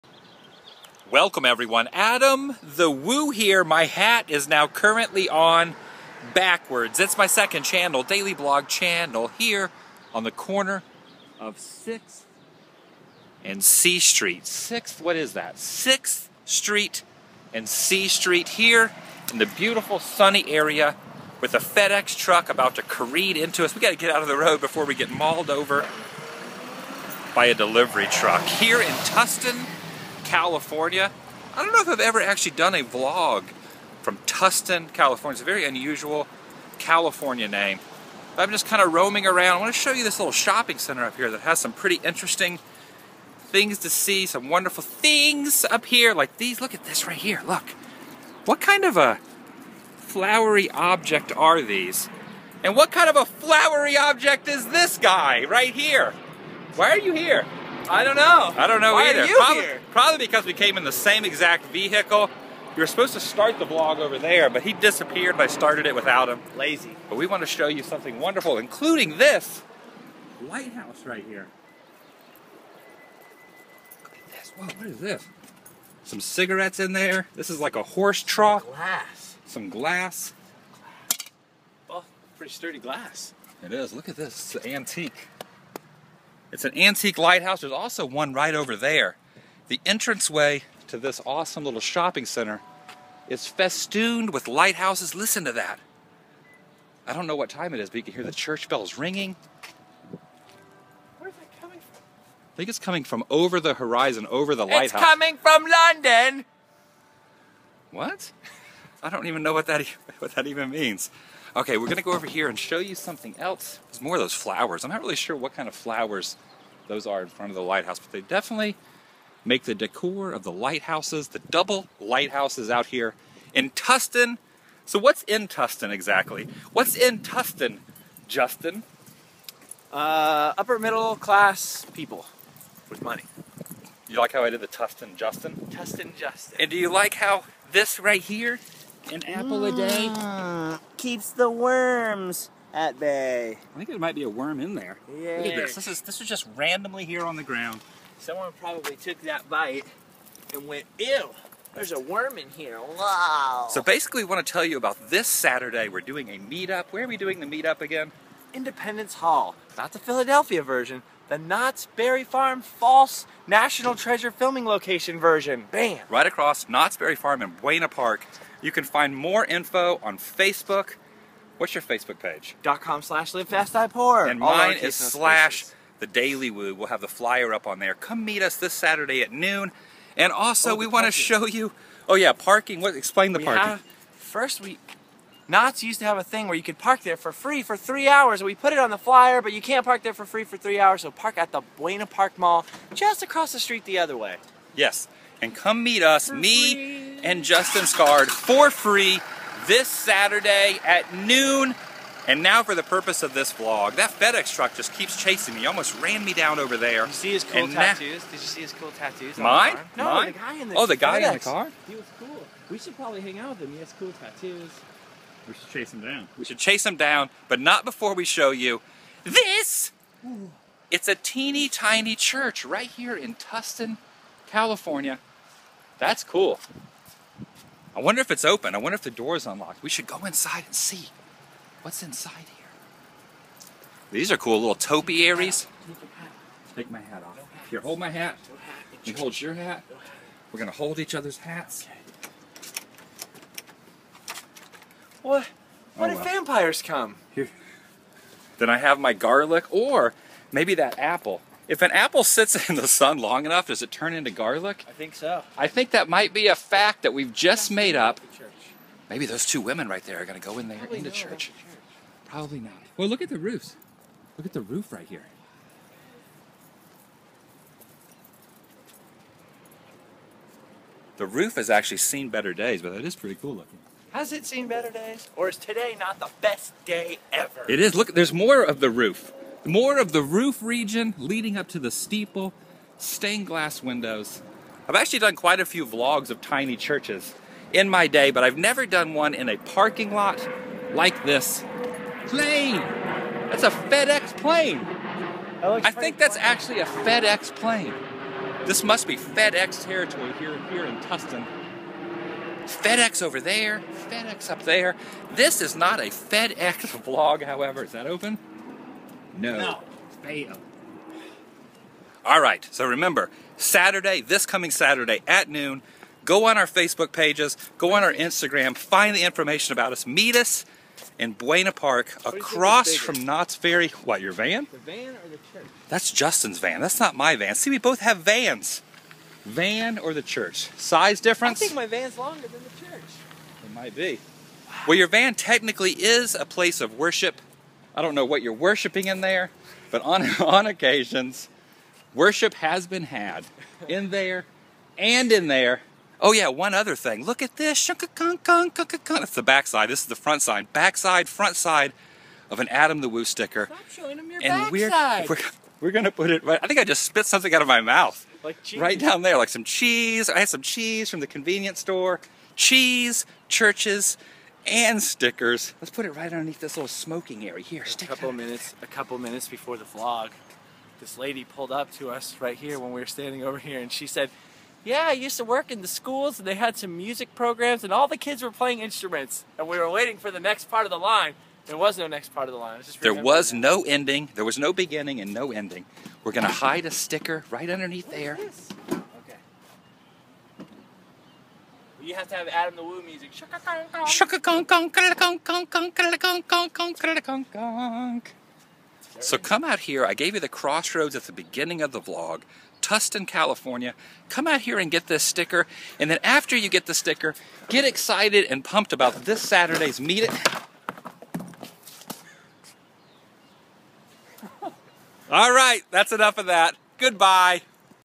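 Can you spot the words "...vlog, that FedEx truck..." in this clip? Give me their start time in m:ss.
3:23.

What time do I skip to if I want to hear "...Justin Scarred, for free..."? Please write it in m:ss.
3:17.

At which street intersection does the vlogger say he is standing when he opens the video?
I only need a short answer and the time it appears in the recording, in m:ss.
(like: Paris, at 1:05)
6th and C Street, at 0:11.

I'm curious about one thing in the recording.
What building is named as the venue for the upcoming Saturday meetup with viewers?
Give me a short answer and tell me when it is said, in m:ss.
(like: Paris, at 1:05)
Independence Hall, at 2:38.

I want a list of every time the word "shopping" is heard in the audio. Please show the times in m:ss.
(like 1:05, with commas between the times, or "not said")
0:40, 1:31.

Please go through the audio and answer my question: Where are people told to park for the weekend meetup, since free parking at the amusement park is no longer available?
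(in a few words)
Buena Park Mall.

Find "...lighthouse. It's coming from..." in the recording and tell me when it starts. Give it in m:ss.
1:44.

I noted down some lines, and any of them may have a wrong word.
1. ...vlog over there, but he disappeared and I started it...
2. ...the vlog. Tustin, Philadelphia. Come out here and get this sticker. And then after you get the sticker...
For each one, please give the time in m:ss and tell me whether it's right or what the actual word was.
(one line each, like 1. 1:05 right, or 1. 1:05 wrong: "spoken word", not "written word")
1. 1:03 right
2. 6:41 wrong: "California", not "Philadelphia".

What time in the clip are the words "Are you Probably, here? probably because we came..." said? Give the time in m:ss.
0:59.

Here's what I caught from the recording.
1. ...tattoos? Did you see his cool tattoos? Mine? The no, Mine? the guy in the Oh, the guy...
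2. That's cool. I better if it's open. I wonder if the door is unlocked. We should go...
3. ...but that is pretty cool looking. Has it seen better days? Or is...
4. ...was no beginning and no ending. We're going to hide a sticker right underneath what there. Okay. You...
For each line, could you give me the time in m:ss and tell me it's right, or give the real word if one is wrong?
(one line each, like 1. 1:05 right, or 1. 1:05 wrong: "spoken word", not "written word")
1. 3:27 right
2. 3:45 wrong: "wonder", not "better"
3. 4:32 right
4. 6:24 right.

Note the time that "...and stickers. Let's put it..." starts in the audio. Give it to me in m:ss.
6:04.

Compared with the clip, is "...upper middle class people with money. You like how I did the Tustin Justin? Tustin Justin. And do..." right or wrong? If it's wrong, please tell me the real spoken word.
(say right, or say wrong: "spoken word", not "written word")
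right.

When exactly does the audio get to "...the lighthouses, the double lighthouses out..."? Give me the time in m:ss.
2:00.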